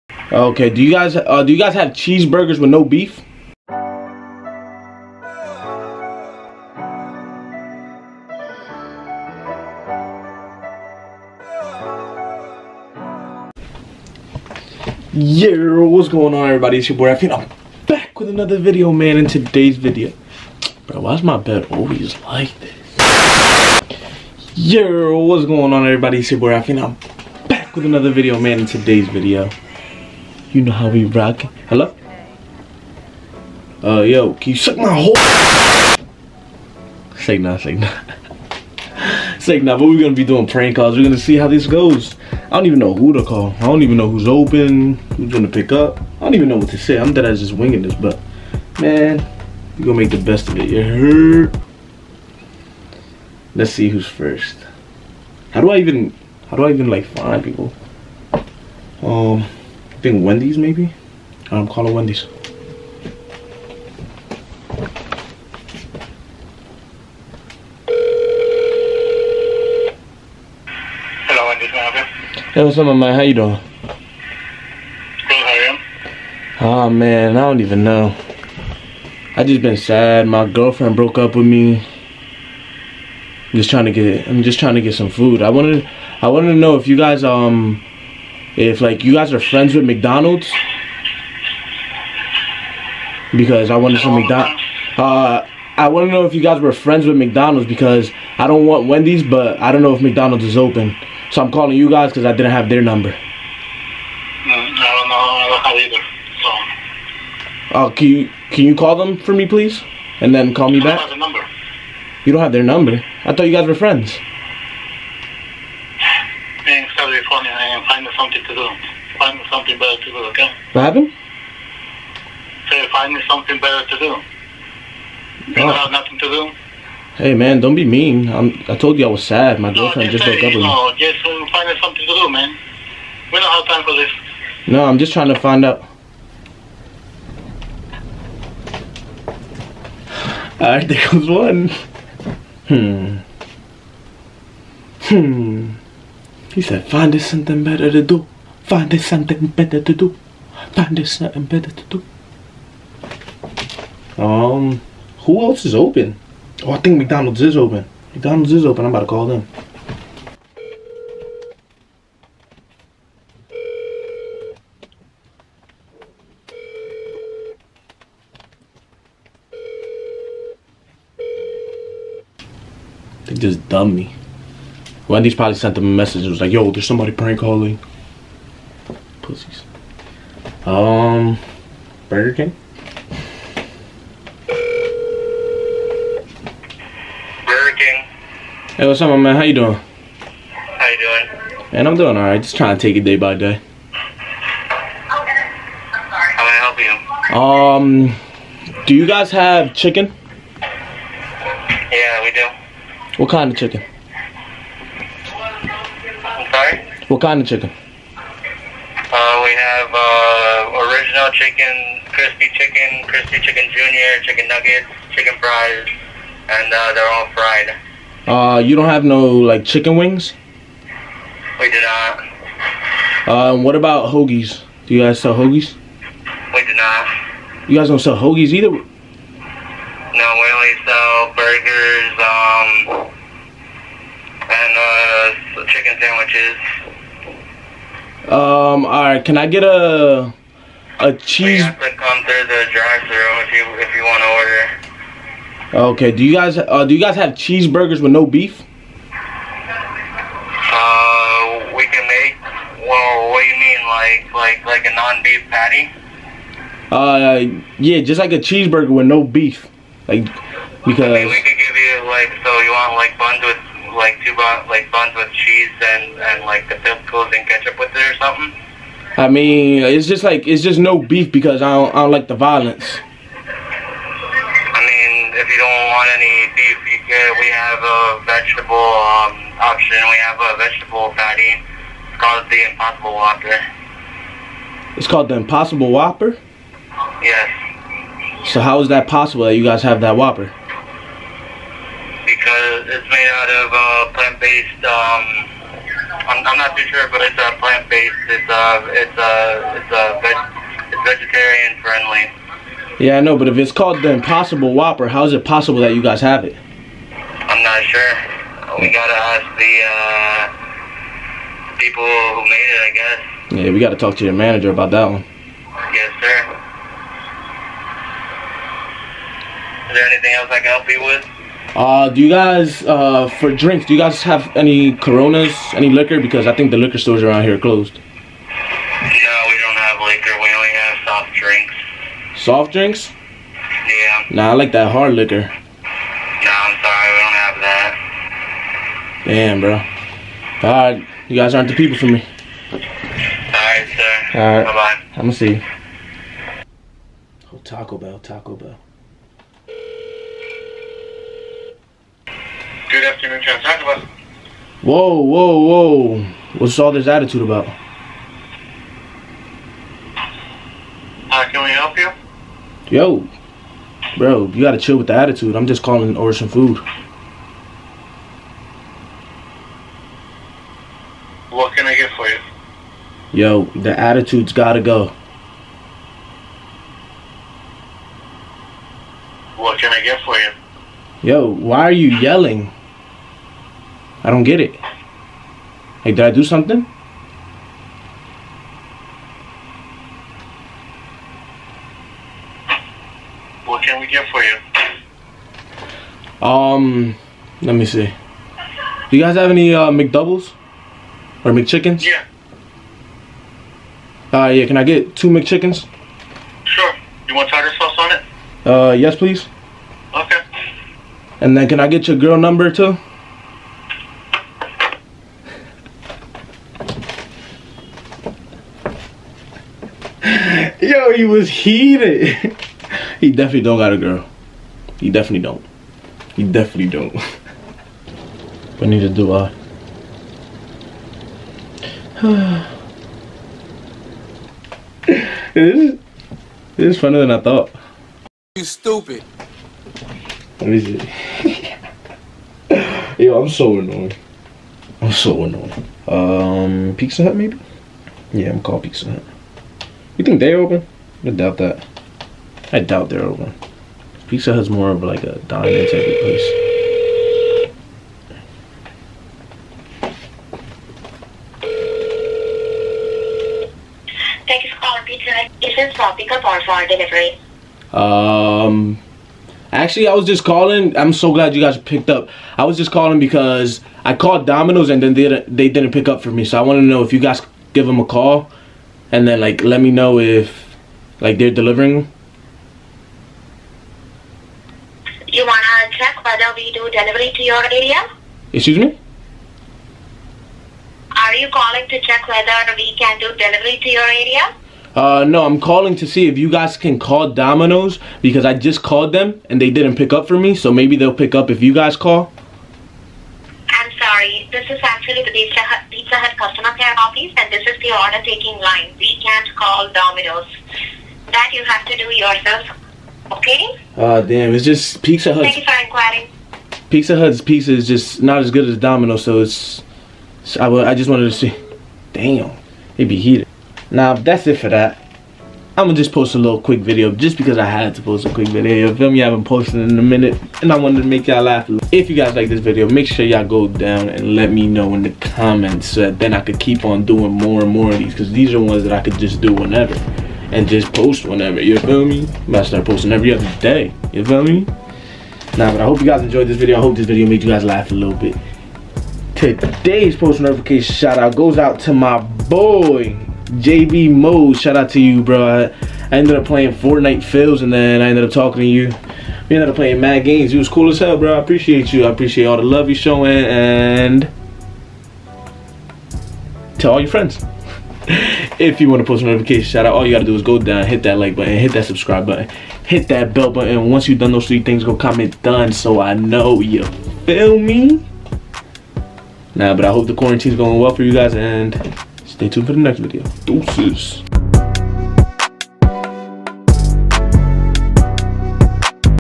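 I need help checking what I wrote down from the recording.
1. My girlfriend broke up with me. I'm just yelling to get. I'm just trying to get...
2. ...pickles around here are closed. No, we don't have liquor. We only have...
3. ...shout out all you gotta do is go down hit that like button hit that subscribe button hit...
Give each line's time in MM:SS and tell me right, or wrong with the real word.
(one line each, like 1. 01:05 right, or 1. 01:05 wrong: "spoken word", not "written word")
1. 01:20 wrong: "trying", not "yelling"
2. 05:26 wrong: "stores", not "pickles"
3. 09:29 right.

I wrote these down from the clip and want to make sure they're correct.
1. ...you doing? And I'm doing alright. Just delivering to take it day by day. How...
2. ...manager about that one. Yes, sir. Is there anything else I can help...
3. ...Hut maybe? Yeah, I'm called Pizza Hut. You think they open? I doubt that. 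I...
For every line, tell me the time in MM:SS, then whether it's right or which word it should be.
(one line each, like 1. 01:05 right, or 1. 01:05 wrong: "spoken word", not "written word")
1. 03:10 wrong: "trying", not "delivering"
2. 05:14 right
3. 07:27 right.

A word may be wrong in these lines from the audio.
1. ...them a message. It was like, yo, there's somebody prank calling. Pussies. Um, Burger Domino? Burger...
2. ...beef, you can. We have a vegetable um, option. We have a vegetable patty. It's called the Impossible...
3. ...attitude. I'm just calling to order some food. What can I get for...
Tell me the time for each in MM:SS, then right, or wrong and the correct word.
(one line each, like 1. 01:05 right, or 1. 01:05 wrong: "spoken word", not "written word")
1. 02:55 wrong: "King", not "Domino"
2. 04:36 right
3. 06:05 right.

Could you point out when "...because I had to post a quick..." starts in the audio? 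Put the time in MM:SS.
08:47.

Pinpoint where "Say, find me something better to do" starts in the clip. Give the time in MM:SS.
02:02.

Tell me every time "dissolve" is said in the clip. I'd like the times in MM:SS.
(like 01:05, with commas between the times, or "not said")
not said.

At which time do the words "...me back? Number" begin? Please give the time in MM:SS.
01:50.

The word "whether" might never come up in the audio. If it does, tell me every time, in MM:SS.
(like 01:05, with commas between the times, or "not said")
08:06, 08:12.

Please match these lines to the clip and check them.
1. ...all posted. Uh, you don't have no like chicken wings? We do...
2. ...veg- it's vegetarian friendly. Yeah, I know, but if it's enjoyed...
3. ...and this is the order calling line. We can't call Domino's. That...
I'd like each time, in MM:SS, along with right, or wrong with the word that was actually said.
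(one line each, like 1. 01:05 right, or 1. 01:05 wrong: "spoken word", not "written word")
1. 03:37 wrong: "fried", not "posted"
2. 05:00 wrong: "called", not "enjoyed"
3. 08:27 wrong: "taking", not "calling".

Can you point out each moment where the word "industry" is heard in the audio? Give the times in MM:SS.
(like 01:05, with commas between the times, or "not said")
not said.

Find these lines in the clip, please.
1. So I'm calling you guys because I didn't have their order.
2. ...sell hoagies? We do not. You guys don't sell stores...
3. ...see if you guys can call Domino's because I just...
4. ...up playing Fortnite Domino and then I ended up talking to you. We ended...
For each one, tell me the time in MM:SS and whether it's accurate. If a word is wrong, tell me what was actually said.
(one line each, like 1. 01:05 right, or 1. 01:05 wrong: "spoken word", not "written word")
1. 01:41 wrong: "number", not "order"
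2. 03:45 wrong: "hoagies", not "stores"
3. 08:16 right
4. 09:16 wrong: "Fills", not "Domino".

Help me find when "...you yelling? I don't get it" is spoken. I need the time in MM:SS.
06:21.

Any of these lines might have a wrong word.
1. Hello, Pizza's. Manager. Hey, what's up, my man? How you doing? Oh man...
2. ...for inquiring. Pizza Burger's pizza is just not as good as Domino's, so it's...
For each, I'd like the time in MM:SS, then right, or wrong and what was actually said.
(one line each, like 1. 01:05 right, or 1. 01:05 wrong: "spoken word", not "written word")
1. 01:11 wrong: "Wendy", not "Pizza"
2. 08:35 wrong: "Hut", not "Burger".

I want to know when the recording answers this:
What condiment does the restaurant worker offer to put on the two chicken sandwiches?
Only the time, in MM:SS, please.
06:47.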